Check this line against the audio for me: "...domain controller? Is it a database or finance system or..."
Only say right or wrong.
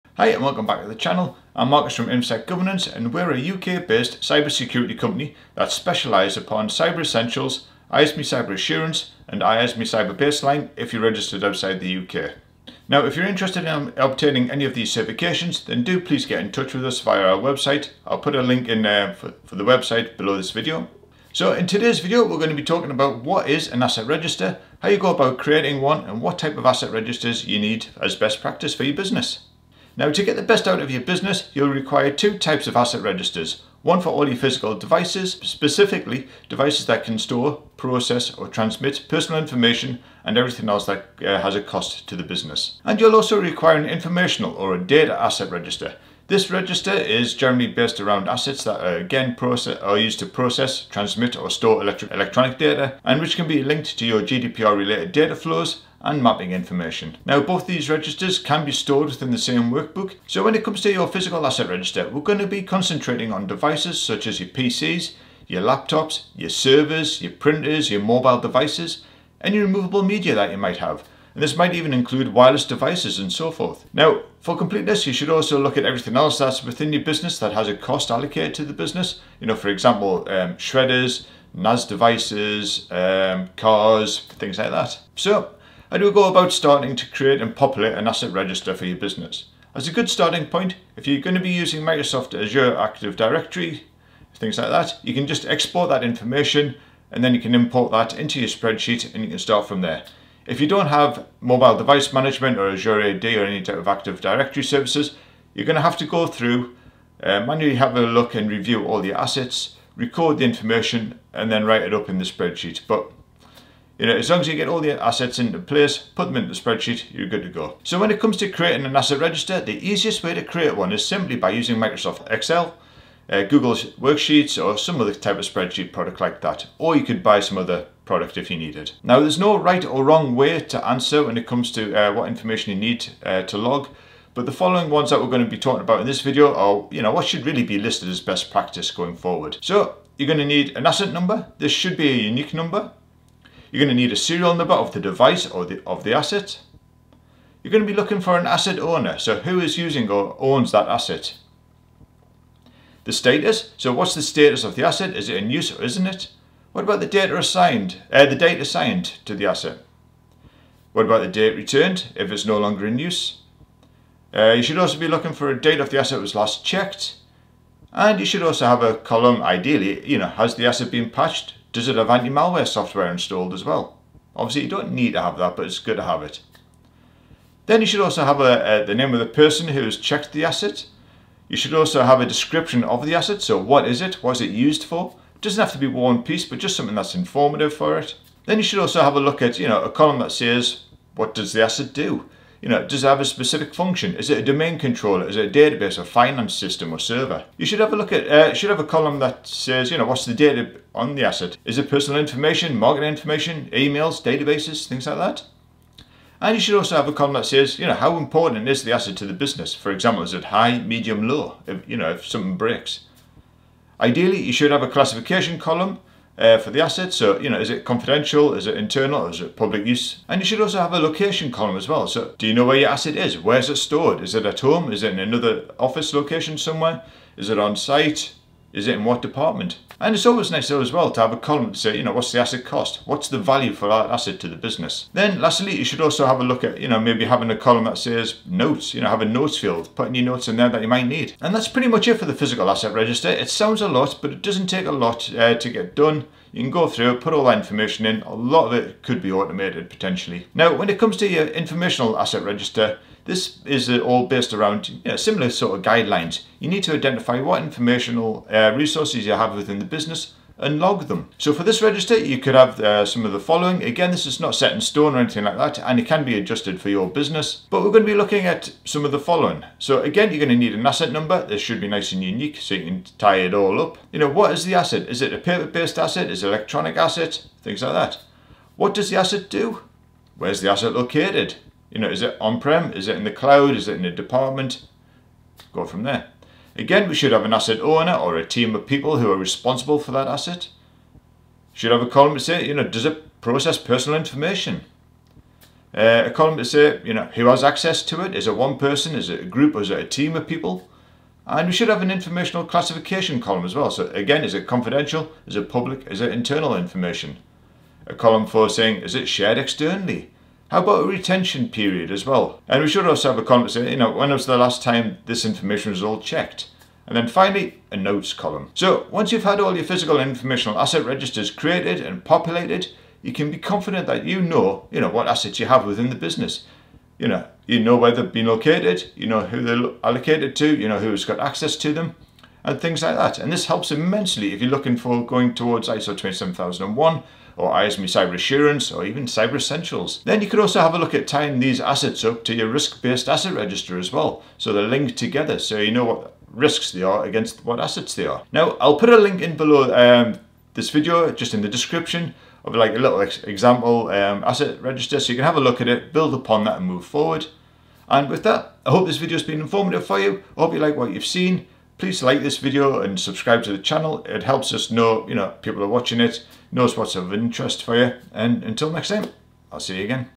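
right.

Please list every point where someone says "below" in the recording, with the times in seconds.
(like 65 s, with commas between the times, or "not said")
20 s, 349 s.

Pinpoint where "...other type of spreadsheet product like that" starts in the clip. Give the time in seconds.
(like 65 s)
124 s.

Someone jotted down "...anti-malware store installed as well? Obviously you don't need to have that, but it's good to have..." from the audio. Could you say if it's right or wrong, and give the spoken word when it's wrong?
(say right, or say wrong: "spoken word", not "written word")
wrong: "software", not "store".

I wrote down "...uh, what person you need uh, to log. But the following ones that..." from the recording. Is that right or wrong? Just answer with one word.
wrong.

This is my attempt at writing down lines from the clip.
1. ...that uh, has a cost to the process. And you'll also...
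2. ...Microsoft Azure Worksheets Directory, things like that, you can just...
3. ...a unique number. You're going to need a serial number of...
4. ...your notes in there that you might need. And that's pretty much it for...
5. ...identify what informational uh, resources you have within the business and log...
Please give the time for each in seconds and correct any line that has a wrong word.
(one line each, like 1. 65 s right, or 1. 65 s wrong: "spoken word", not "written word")
1. 40 s wrong: "business", not "process"
2. 91 s wrong: "Active", not "Worksheets"
3. 142 s right
4. 240 s right
5. 256 s right.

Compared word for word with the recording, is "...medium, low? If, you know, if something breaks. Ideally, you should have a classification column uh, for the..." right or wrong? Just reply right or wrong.
right.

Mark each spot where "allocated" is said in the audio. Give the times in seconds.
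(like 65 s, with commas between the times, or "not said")
78 s, 330 s.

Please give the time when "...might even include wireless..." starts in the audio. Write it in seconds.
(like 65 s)
71 s.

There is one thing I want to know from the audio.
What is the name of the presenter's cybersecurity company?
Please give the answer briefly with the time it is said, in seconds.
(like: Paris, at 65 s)
InfoSec Governance, at 2 s.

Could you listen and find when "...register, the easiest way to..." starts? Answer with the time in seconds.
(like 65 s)
119 s.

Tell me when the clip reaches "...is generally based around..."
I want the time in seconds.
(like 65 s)
46 s.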